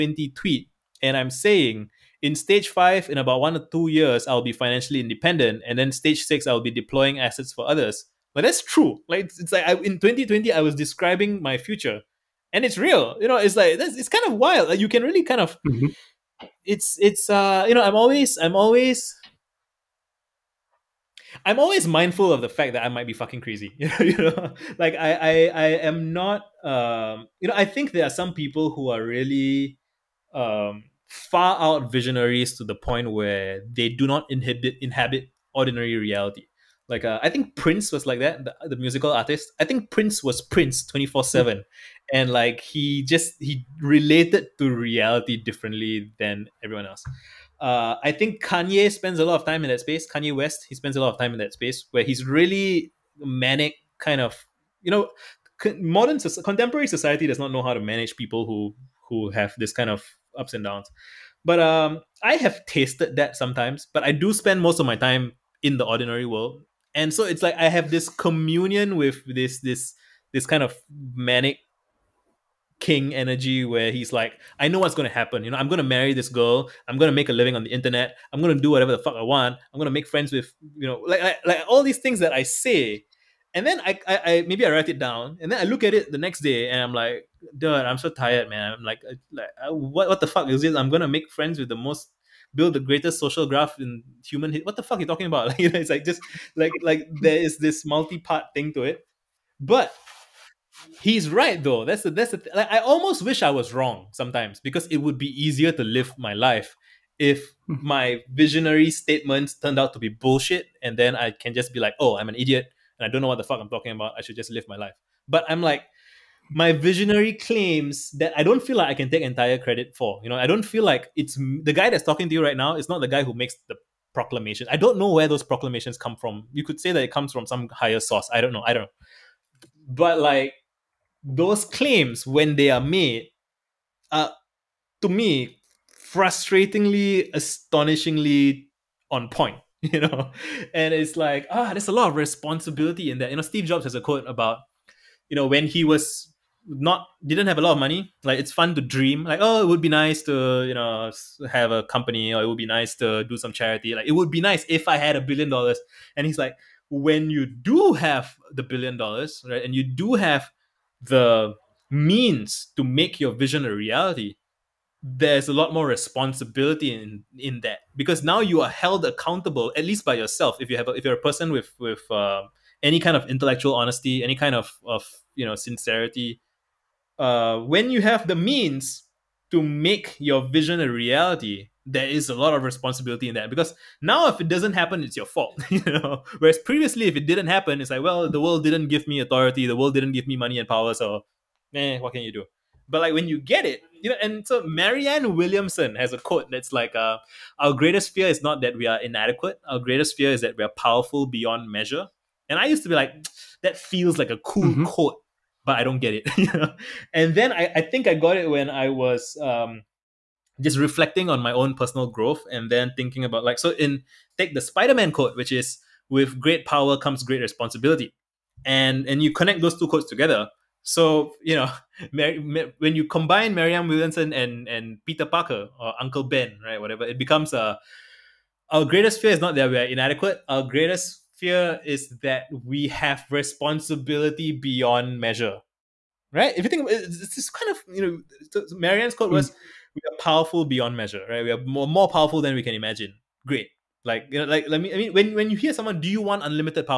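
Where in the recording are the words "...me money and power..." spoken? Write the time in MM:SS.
03:10.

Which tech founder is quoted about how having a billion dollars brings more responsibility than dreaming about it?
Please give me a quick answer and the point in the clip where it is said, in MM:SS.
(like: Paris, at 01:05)
Steve Jobs, at 02:23.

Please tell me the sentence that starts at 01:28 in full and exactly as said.
I'm like, like uh, what what the fuck is this?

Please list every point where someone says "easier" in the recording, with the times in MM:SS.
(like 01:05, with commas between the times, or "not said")
01:45.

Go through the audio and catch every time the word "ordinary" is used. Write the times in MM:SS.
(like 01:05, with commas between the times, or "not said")
00:35, 01:05.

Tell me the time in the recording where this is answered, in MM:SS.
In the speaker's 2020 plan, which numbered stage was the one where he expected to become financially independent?
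00:02.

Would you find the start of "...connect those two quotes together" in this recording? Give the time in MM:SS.
03:39.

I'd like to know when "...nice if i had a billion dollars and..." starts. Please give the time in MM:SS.
02:34.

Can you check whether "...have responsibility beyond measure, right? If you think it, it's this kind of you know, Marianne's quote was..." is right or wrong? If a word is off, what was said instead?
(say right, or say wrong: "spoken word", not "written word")
right.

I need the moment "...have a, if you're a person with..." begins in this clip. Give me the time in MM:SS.
02:50.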